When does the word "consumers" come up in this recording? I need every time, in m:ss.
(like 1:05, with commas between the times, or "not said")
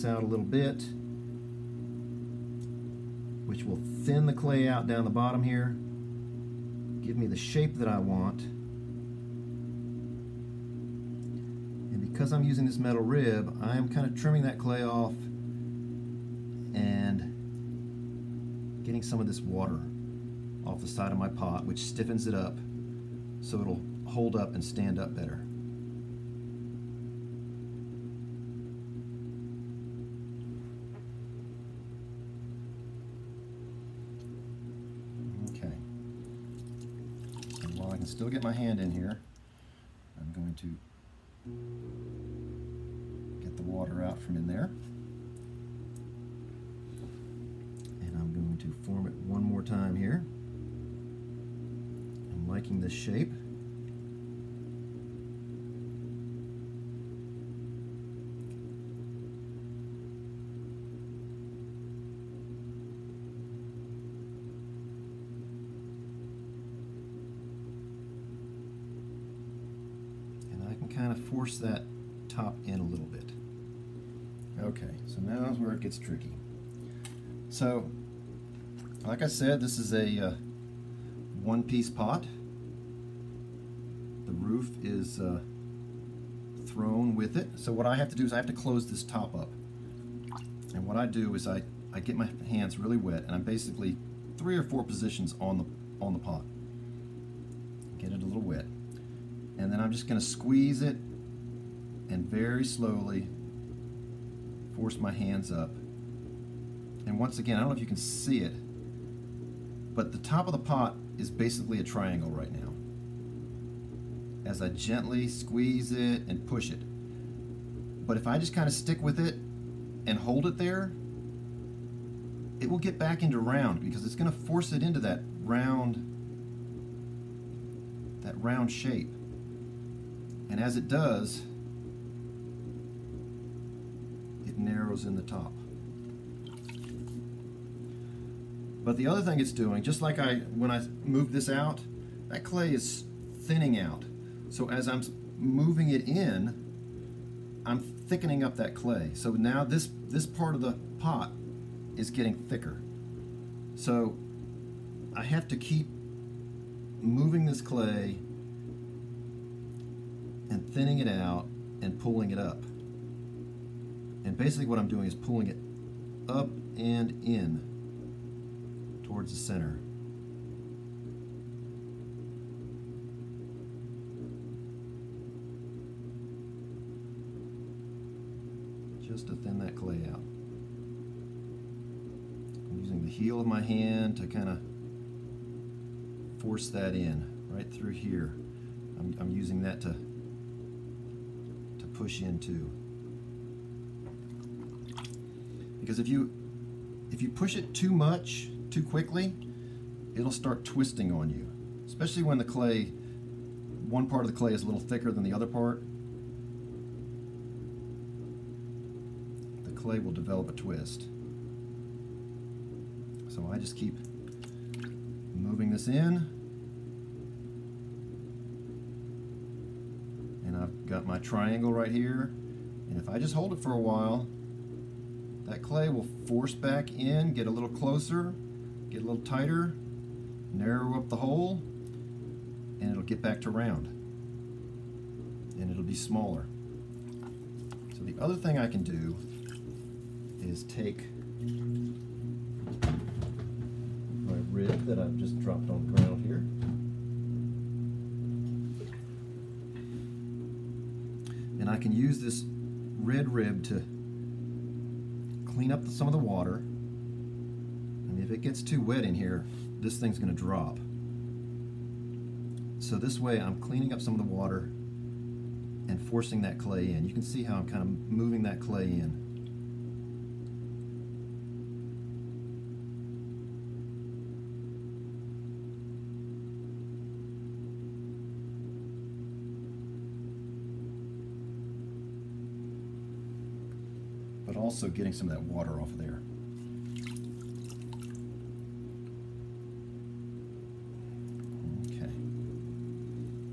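not said.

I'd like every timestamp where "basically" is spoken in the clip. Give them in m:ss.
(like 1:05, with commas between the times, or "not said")
1:33, 1:51, 2:44.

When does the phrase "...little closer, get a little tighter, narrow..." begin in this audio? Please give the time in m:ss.
3:47.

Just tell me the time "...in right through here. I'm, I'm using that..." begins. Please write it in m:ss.
3:06.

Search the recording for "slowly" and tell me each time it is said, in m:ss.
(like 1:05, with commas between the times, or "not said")
1:42.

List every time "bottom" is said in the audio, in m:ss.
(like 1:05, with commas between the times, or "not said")
0:05.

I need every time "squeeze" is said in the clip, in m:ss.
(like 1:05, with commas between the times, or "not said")
1:40, 1:55.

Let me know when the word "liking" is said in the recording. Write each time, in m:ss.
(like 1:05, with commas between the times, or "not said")
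0:52.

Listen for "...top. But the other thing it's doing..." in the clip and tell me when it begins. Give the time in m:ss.
2:15.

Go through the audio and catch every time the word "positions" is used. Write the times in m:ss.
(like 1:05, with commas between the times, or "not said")
1:34.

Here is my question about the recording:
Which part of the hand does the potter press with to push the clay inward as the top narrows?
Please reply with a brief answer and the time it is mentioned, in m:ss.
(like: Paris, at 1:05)
Heel, at 3:03.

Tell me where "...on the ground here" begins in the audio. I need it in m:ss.
4:05.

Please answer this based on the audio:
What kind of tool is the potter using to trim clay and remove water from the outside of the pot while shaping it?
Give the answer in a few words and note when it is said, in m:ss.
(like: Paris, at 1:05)
Metal rib, at 0:12.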